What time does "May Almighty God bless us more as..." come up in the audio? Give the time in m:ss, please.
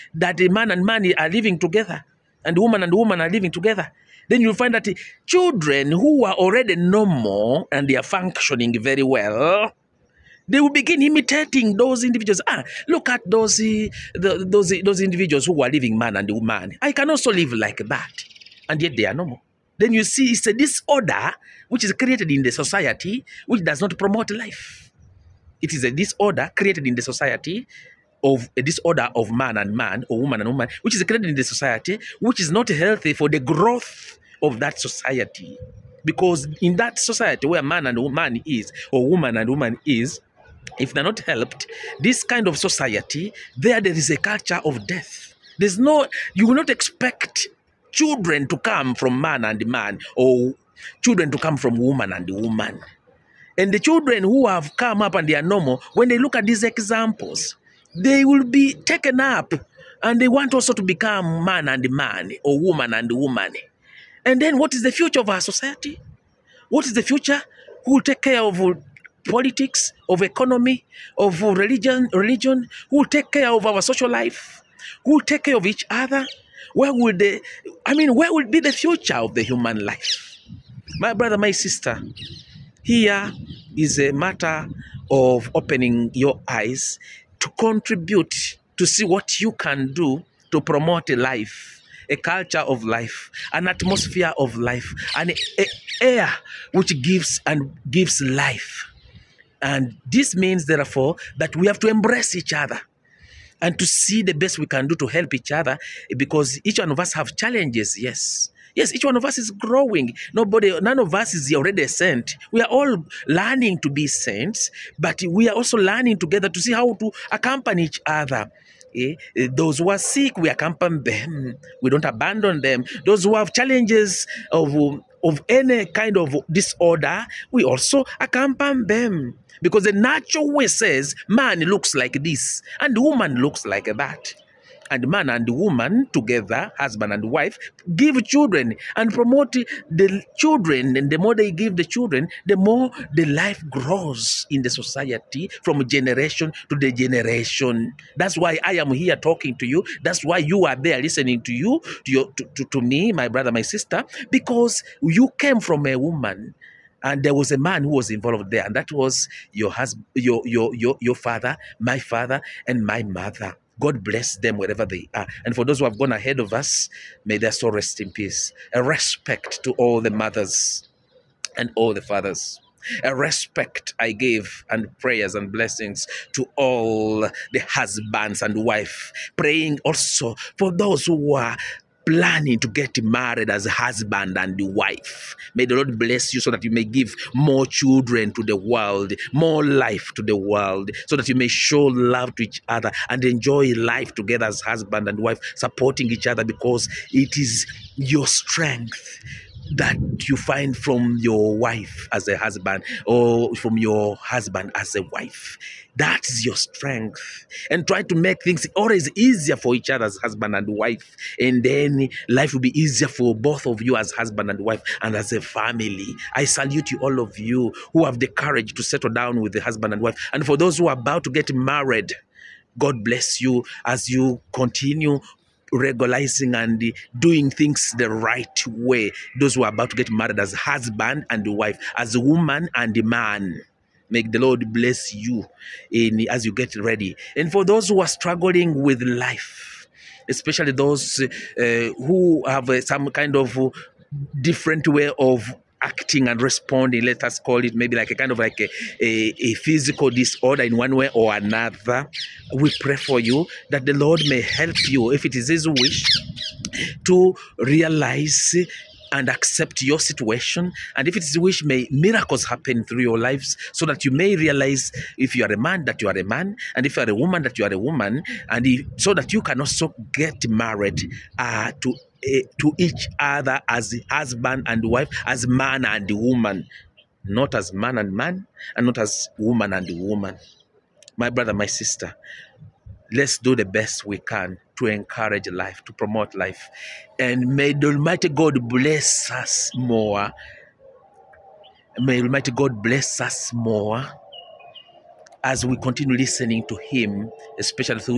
4:51.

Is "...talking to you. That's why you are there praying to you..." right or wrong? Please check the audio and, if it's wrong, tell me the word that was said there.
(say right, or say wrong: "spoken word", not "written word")
wrong: "listening", not "praying".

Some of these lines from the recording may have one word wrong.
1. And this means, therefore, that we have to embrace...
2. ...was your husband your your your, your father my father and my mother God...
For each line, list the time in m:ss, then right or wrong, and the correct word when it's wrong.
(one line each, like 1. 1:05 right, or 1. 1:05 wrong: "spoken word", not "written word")
1. 1:39 right
2. 2:38 right.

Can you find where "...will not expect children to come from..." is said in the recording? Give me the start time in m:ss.
0:46.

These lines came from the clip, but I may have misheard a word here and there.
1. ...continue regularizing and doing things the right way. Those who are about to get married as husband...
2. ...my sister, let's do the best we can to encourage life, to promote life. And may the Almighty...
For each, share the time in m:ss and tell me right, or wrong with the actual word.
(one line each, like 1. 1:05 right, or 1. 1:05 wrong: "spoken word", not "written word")
1. 3:44 right
2. 4:41 right.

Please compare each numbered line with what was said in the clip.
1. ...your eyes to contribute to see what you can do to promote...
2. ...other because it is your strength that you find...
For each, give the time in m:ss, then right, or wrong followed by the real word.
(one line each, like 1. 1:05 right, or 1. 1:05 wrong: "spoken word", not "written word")
1. 1:26 right
2. 3:16 right.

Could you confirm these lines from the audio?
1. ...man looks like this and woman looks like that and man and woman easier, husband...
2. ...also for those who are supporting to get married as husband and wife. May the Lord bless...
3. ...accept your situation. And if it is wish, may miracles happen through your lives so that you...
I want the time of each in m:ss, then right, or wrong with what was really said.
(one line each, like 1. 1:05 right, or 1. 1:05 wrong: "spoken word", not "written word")
1. 2:11 wrong: "together", not "easier"
2. 2:59 wrong: "planning", not "supporting"
3. 4:19 right.